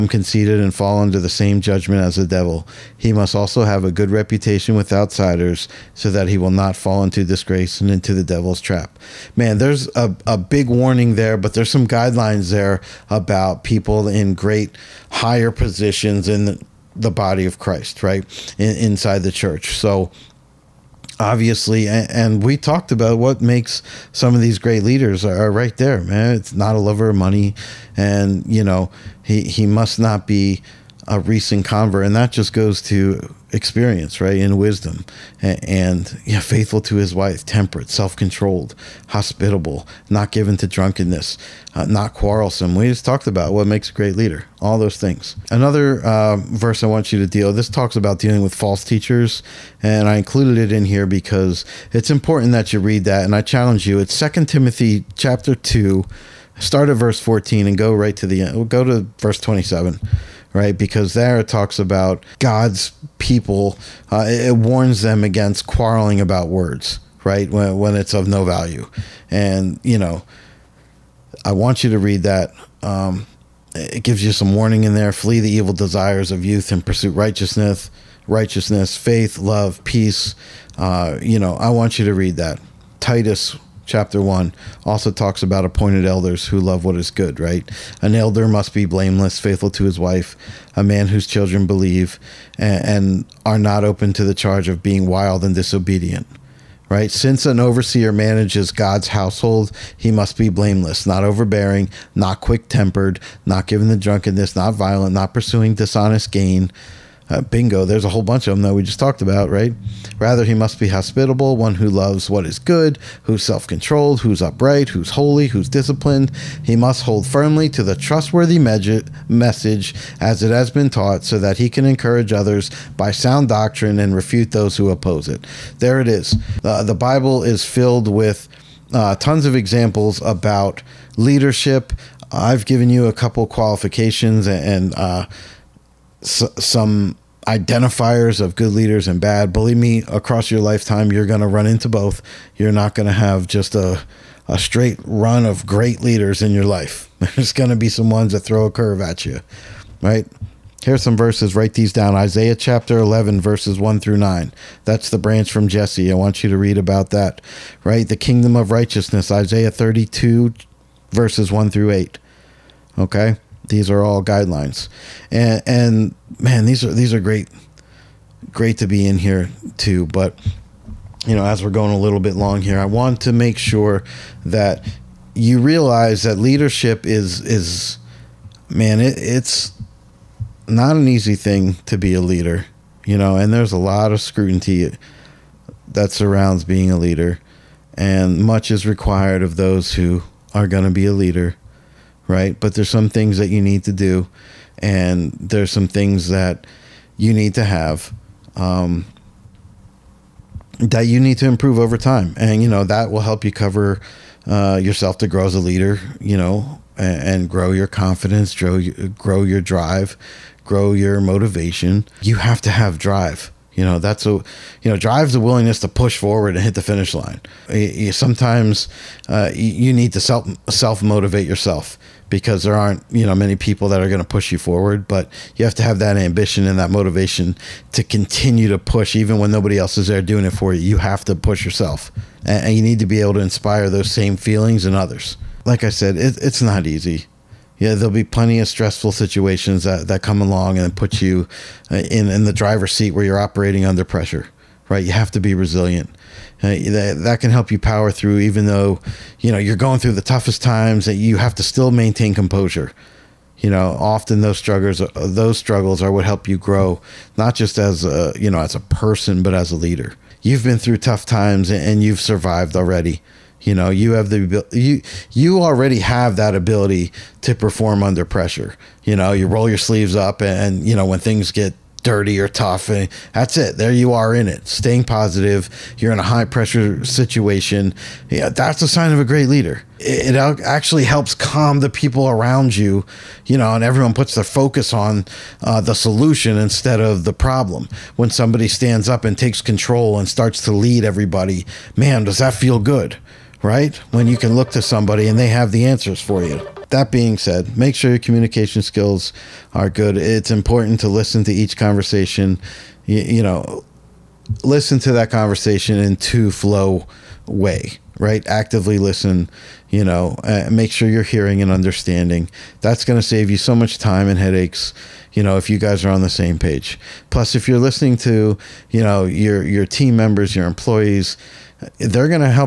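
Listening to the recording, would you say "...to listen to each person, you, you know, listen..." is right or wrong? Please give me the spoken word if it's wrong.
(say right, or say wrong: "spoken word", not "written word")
wrong: "conversation", not "person".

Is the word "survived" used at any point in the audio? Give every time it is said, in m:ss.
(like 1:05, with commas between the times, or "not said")
4:22.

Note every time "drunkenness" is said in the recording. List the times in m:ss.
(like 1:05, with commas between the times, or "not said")
0:40, 1:43.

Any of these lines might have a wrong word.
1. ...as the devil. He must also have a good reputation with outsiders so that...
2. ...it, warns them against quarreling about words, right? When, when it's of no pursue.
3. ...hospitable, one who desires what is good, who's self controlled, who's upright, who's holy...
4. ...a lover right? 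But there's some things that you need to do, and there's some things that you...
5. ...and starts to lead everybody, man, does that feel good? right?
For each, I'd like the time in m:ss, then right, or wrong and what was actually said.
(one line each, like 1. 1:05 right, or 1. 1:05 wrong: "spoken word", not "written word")
1. 0:02 right
2. 1:04 wrong: "value", not "pursue"
3. 1:50 wrong: "loves", not "desires"
4. 3:11 wrong: "leader", not "lover"
5. 4:50 right.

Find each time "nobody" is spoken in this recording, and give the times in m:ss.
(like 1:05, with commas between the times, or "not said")
3:49.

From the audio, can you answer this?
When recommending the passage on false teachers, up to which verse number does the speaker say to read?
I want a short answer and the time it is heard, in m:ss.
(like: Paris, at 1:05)
27, at 0:59.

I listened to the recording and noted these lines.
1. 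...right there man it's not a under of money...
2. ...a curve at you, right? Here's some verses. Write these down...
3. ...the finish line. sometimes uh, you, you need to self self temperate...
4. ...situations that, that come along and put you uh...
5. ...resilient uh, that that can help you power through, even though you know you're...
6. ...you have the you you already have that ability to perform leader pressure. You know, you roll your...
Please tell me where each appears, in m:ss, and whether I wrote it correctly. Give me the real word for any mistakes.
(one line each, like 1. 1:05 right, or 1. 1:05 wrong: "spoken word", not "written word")
1. 0:25 wrong: "lover", not "under"
2. 2:28 right
3. 3:36 wrong: "motivate", not "temperate"
4. 3:59 right
5. 4:05 right
6. 4:23 wrong: "under", not "leader".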